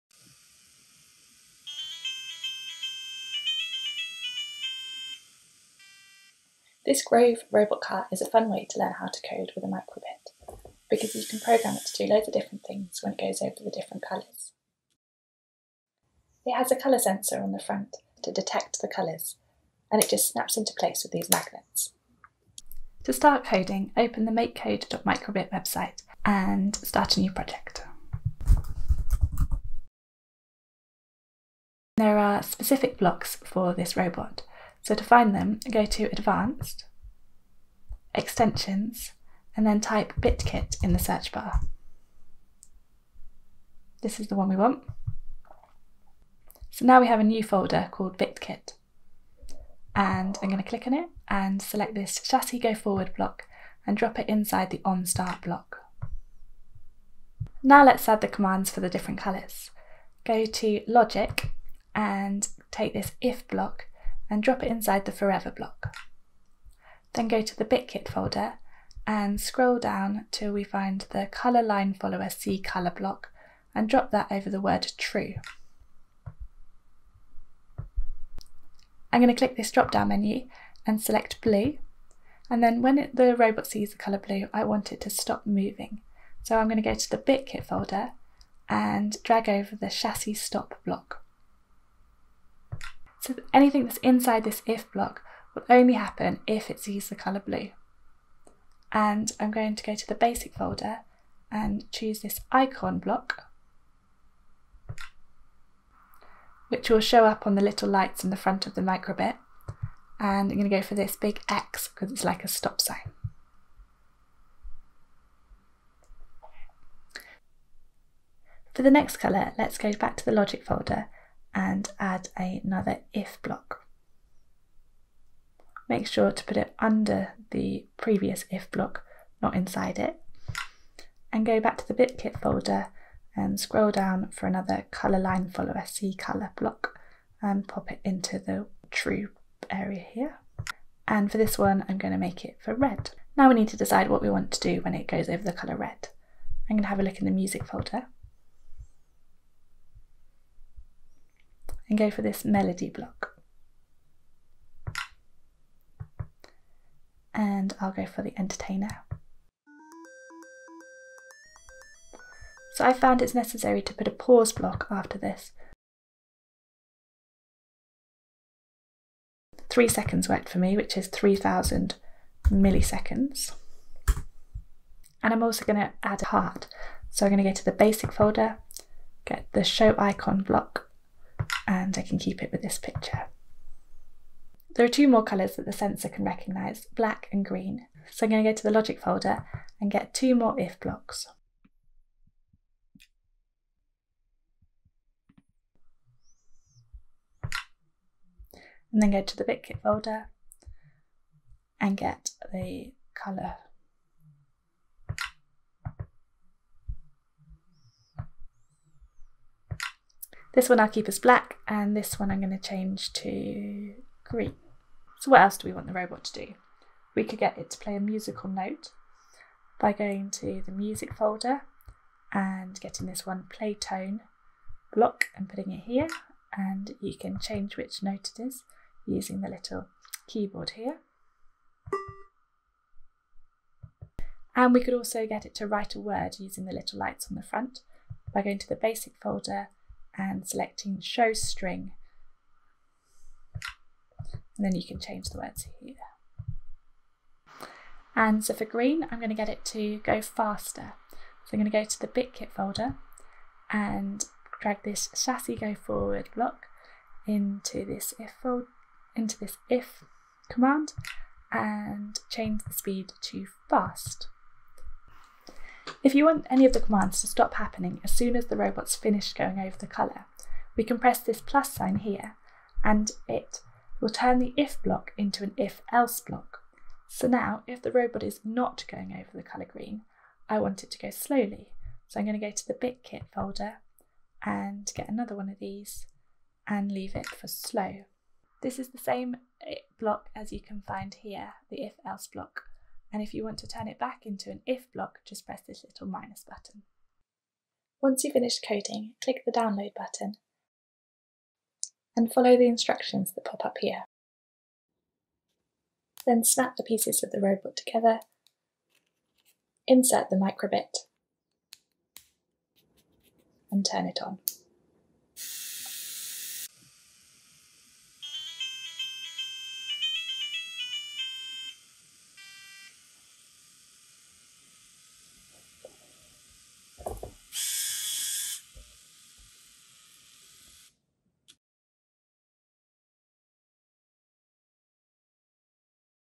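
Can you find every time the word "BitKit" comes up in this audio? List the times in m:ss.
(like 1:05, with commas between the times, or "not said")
0:40, 0:48, 1:07, 1:27, 2:11, 3:19, 4:12, 4:42.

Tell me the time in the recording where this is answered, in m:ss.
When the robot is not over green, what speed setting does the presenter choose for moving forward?
4:47.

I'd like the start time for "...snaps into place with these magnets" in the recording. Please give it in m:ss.
0:20.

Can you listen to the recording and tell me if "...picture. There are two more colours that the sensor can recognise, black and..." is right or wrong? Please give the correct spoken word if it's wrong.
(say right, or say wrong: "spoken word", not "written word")
right.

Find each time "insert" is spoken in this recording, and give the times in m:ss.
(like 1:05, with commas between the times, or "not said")
5:09.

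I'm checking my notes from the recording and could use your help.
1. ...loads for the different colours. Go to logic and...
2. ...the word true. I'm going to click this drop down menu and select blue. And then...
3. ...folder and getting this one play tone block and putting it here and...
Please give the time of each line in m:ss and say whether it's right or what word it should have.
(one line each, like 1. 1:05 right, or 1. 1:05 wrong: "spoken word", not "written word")
1. 0:58 wrong: "commands", not "loads"
2. 1:14 right
3. 3:41 right.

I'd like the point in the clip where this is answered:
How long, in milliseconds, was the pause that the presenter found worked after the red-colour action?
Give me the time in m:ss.
2:51.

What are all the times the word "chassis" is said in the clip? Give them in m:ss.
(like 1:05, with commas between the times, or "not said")
0:52, 1:29, 4:15.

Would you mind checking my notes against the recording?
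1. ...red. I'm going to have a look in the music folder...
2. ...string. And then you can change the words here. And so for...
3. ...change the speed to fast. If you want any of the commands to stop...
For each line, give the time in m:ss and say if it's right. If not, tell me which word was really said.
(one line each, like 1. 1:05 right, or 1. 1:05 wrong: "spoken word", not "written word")
1. 2:25 right
2. 4:01 right
3. 4:22 right.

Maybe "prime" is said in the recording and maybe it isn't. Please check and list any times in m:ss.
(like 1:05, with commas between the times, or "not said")
not said.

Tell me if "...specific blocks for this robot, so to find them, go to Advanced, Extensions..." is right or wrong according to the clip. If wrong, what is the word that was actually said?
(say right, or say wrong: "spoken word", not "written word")
right.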